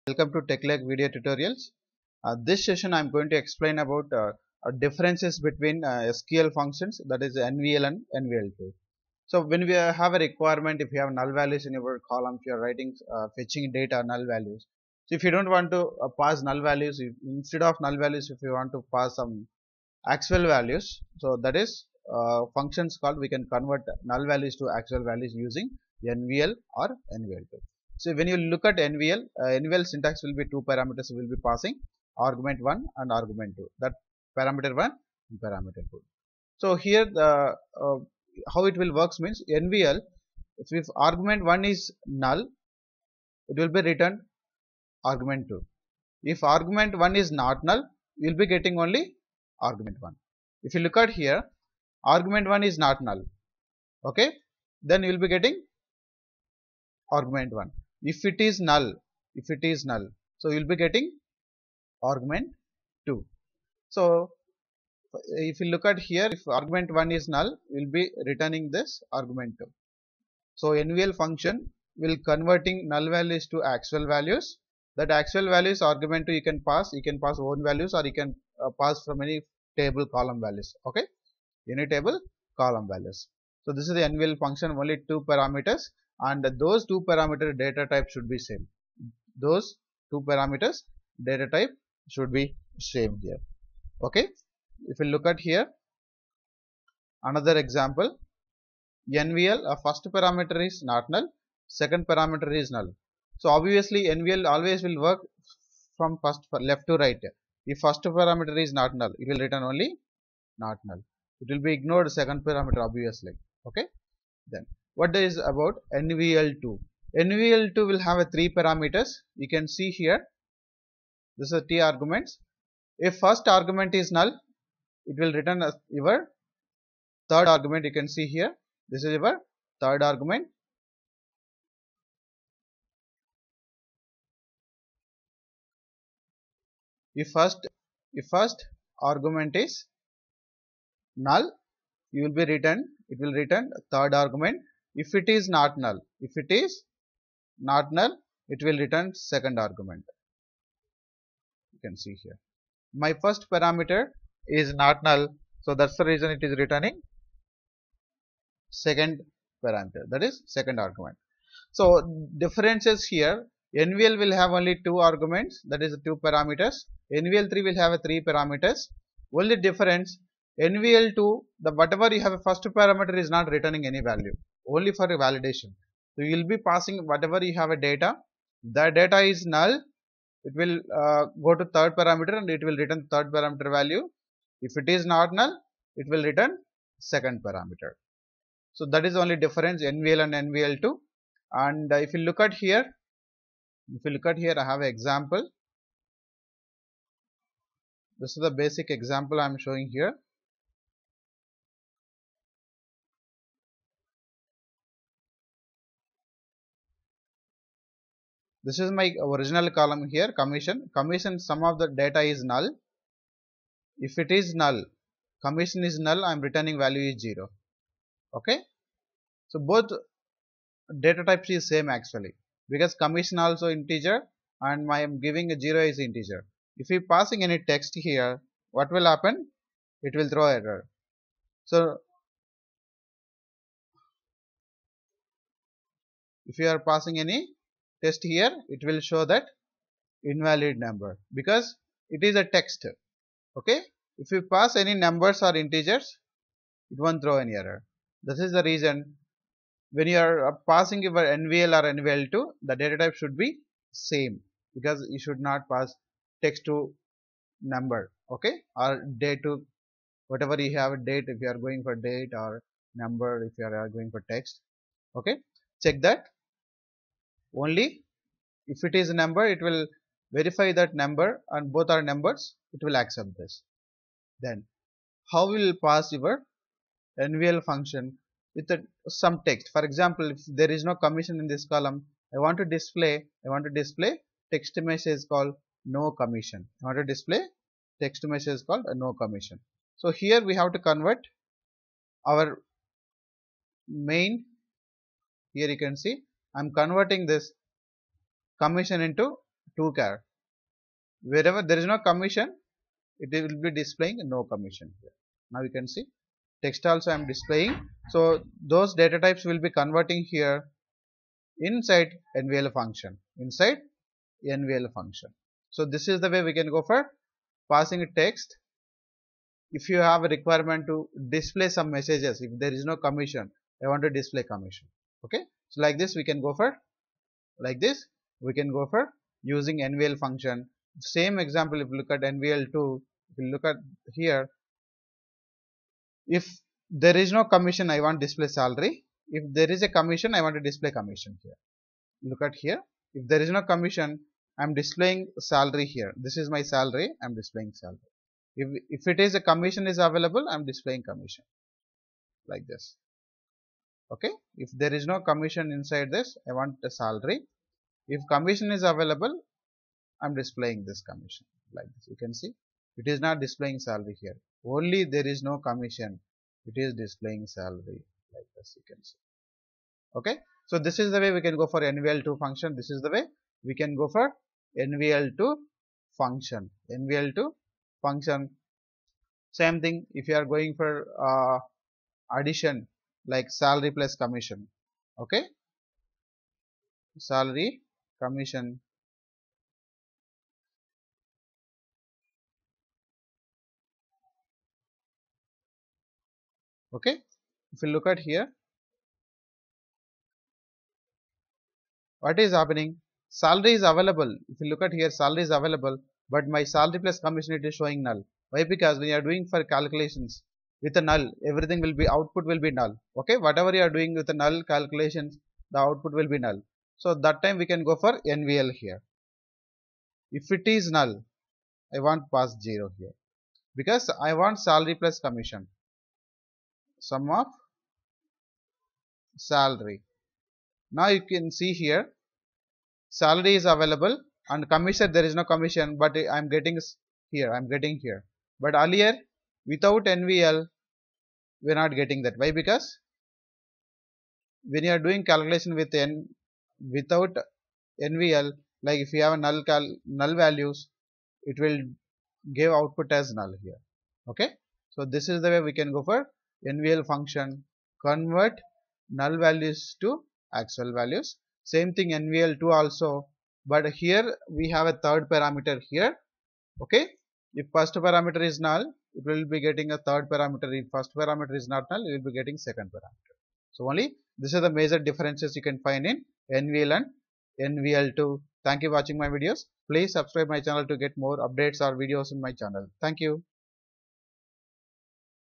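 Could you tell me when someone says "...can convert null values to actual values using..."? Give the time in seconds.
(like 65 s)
23 s.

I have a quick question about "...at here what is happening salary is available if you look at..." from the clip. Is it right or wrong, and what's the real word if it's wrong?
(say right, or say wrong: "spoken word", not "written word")
right.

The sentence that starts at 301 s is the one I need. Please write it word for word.
Wherever there is no commission, it will be displaying no commission here.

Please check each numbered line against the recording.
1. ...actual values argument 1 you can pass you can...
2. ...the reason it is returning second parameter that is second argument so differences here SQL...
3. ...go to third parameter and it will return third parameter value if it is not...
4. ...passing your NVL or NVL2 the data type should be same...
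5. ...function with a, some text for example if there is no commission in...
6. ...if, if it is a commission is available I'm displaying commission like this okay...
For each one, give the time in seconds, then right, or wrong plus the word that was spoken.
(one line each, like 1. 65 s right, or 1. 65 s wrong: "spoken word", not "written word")
1. 75 s wrong: "2", not "1"
2. 156 s wrong: "NVL", not "SQL"
3. 181 s right
4. 250 s right
5. 277 s right
6. 348 s right.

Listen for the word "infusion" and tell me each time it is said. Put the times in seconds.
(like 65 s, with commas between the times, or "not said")
not said.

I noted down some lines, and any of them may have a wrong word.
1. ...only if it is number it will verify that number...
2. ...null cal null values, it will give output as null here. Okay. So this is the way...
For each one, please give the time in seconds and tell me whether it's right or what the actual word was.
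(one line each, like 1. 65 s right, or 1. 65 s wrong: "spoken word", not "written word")
1. 267 s right
2. 449 s right.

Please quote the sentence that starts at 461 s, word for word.
Same thing NVL2 also, but here we have a third parameter here.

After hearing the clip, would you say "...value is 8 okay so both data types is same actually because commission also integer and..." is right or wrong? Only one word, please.
wrong.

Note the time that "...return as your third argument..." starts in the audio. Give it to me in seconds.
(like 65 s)
125 s.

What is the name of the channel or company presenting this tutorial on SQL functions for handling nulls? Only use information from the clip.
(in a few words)
TechLake.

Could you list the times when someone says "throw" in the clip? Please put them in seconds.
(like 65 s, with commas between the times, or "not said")
230 s, 247 s.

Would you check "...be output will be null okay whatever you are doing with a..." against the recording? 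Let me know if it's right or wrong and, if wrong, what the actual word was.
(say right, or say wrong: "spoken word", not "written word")
right.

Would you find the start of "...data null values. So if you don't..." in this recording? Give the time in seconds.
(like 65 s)
13 s.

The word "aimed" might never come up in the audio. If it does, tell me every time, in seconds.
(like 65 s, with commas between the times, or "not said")
not said.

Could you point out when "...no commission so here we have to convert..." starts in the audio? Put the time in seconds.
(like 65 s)
288 s.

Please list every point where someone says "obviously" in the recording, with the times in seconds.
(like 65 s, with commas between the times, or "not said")
103 s, 112 s.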